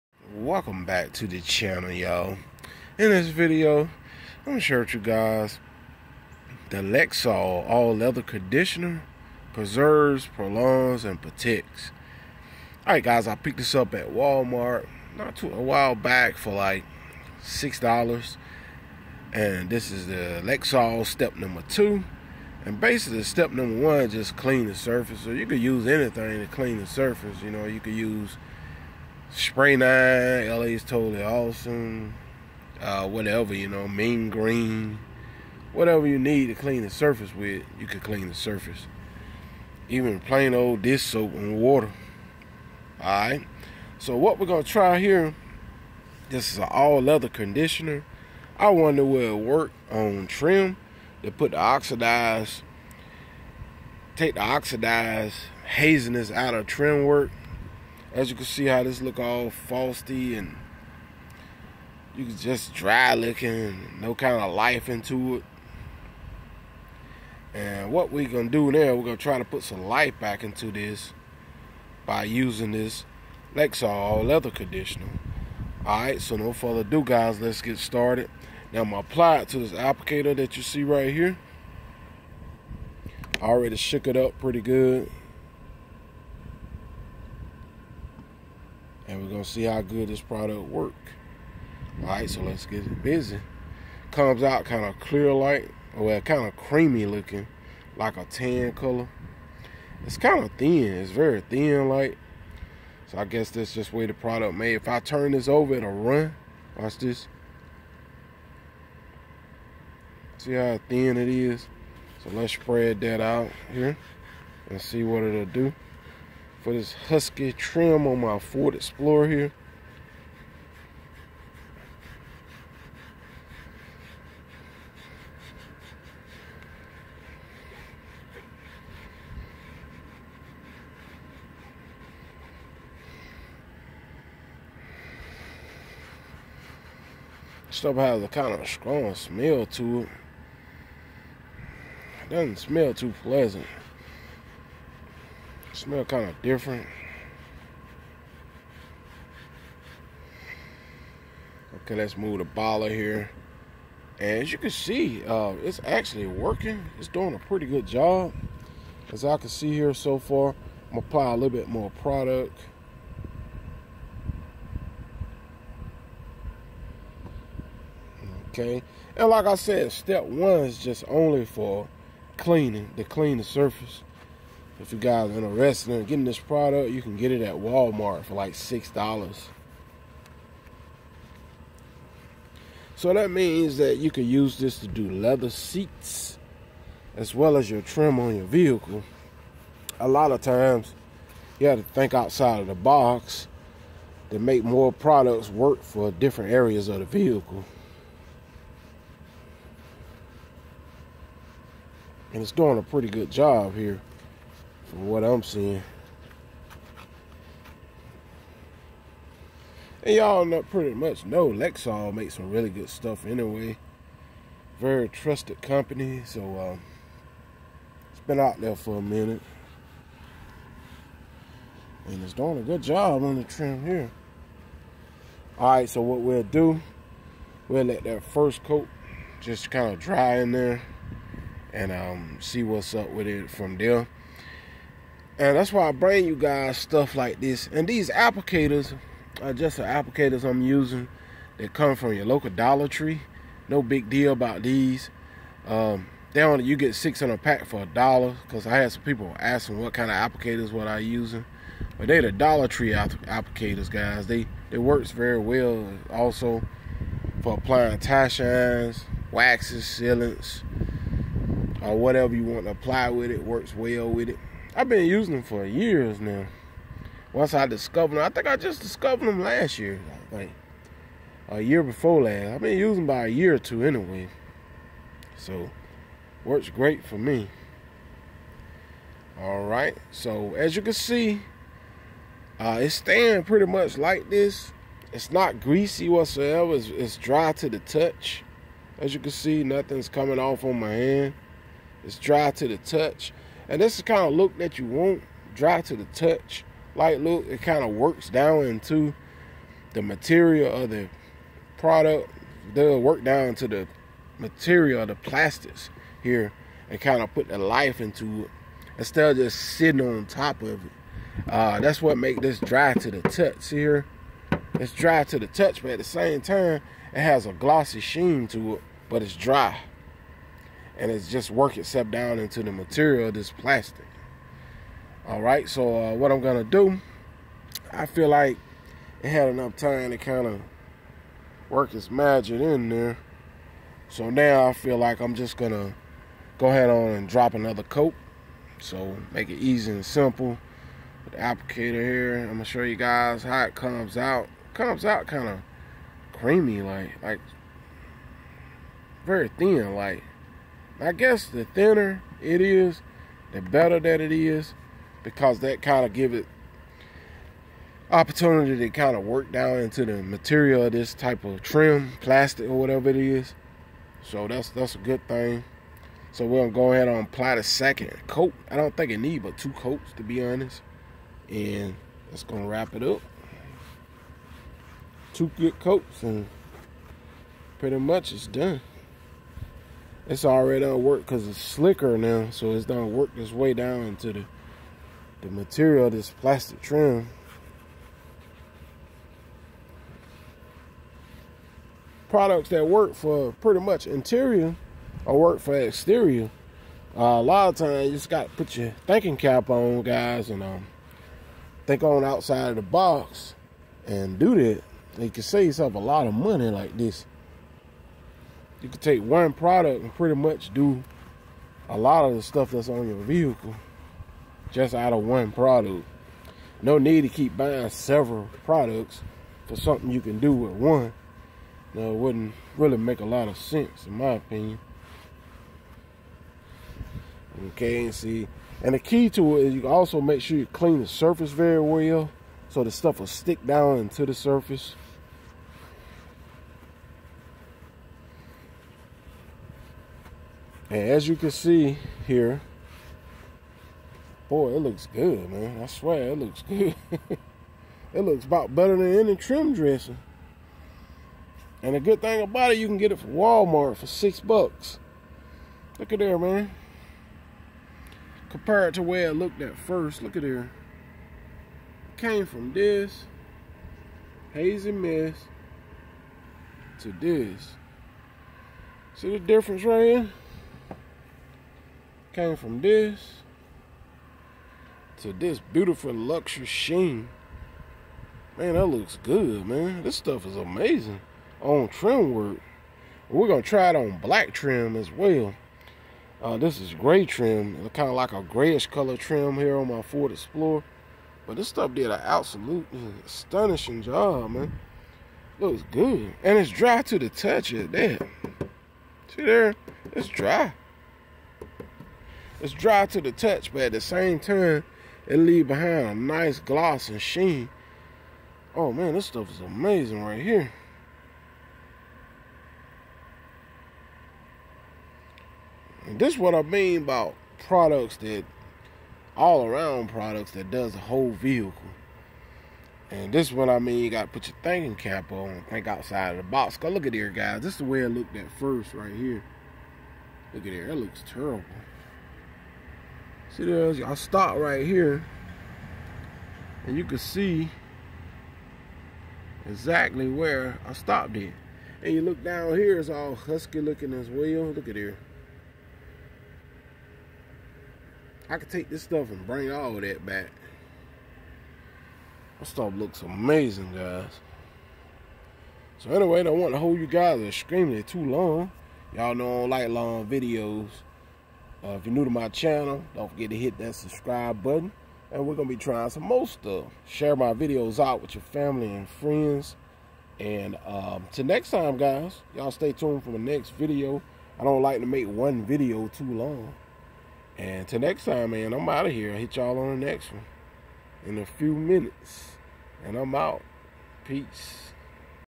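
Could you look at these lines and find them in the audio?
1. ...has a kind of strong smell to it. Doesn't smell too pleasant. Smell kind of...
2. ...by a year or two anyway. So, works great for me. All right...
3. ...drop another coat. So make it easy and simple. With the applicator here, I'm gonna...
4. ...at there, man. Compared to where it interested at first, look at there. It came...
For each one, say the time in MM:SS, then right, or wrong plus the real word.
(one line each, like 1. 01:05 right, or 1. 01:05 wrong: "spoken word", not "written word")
1. 02:17 right
2. 04:33 right
3. 05:37 right
4. 07:36 wrong: "looked", not "interested".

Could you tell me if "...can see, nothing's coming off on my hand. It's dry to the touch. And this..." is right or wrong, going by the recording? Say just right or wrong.
right.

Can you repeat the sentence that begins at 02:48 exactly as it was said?
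Okay, and like I said, step one is just only for cleaning, to clean the surface.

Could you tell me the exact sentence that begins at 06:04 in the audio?
So that's that's a good thing.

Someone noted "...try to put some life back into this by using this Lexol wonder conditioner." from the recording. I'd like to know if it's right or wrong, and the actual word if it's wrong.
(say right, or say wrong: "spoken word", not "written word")
wrong: "leather", not "wonder".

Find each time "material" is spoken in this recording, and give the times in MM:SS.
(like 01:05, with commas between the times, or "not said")
05:00, 05:04, 05:22, 06:00, 06:25.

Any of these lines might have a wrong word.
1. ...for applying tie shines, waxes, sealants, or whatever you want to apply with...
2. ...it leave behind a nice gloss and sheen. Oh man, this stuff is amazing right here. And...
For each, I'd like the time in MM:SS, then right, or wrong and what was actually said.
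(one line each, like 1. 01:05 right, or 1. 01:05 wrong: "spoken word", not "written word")
1. 04:17 right
2. 08:25 right.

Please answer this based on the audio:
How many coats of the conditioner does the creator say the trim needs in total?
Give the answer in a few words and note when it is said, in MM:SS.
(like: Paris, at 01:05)
2, at 06:09.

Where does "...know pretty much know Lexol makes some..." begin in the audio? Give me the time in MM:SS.
03:30.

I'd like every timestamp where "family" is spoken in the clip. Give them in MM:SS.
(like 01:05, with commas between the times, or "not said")
09:28.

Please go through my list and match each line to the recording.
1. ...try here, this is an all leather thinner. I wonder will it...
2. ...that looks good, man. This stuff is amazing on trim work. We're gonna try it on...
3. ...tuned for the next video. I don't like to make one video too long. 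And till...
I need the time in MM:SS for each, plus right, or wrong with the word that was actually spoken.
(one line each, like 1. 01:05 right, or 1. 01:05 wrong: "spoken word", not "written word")
1. 00:44 wrong: "conditioner", not "thinner"
2. 07:58 right
3. 09:32 right.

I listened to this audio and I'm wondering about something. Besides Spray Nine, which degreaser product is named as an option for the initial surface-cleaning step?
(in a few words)
Totally Awesome.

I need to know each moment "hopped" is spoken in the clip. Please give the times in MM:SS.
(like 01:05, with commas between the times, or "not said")
not said.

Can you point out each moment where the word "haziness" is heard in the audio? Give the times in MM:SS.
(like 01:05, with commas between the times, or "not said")
00:55.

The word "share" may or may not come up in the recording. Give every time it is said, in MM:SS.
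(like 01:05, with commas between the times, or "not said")
00:04, 09:27.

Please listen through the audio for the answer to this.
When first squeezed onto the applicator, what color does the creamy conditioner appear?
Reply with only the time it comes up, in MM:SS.
01:38.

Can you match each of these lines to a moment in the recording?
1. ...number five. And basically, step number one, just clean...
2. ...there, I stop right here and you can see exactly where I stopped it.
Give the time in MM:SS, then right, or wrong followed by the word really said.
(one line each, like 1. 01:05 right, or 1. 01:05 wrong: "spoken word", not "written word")
1. 00:21 wrong: "two", not "five"
2. 08:53 right.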